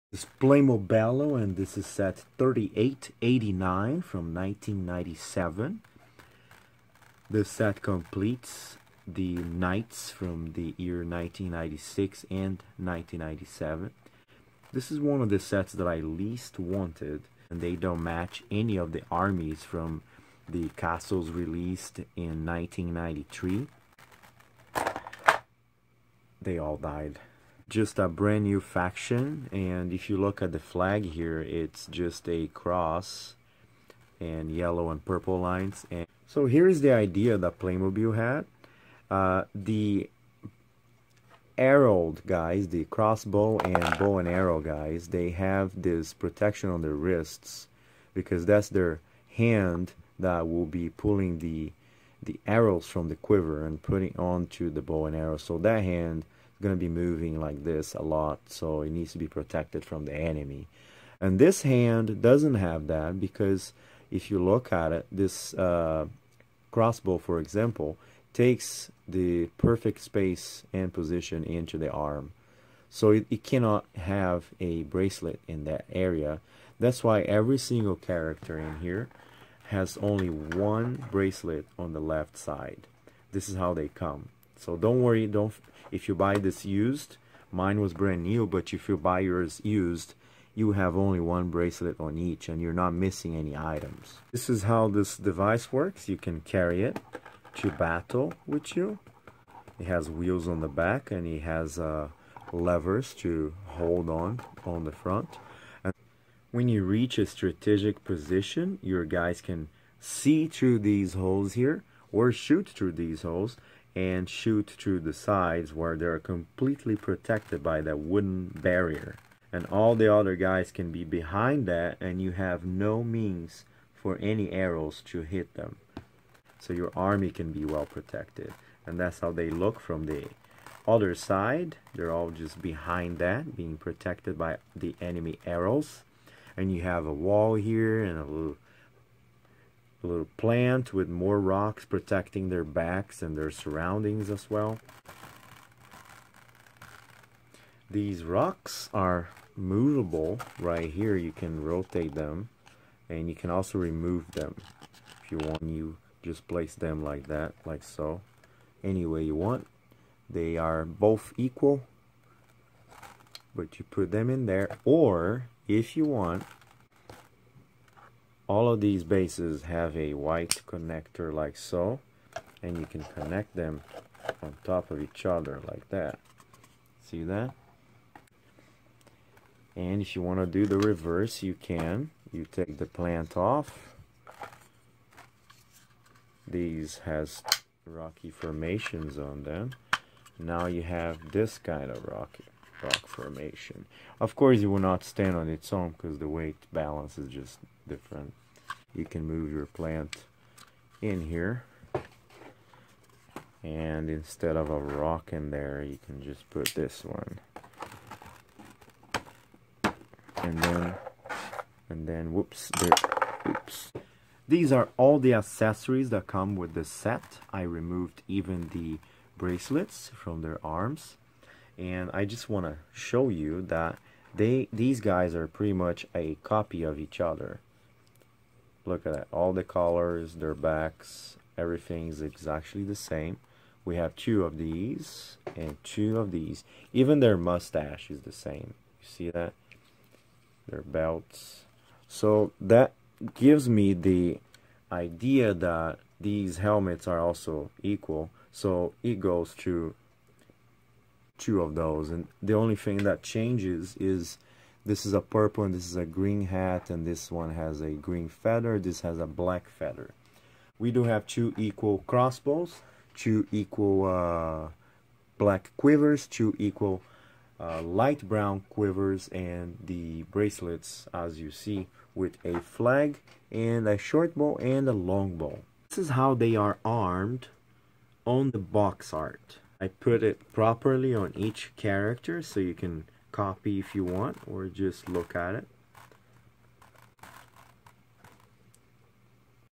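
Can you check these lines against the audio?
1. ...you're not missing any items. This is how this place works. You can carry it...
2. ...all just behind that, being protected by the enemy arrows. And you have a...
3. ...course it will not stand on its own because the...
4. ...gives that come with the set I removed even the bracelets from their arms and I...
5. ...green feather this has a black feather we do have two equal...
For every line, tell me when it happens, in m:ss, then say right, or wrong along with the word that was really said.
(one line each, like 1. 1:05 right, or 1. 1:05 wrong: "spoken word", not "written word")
1. 1:32 wrong: "device", not "place"
2. 2:12 right
3. 3:14 right
4. 3:35 wrong: "accessories", not "gives"
5. 4:17 right.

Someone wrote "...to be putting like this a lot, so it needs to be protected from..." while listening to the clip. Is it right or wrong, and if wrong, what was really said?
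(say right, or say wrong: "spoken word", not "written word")
wrong: "moving", not "putting".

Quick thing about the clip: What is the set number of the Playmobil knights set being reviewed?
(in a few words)
3889.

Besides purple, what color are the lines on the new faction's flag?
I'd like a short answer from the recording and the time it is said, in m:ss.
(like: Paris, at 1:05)
yellow, at 0:34.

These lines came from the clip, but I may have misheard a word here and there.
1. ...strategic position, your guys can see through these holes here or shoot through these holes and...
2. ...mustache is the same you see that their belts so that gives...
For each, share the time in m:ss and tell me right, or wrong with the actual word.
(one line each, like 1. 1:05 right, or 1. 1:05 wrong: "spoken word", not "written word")
1. 1:47 right
2. 3:57 right.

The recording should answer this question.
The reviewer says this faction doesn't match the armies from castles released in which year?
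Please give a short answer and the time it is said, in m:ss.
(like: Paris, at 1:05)
1993, at 0:22.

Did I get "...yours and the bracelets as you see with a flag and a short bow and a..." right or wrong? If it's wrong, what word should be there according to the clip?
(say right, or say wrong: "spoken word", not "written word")
wrong: "quivers", not "yours".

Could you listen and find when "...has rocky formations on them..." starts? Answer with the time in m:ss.
3:07.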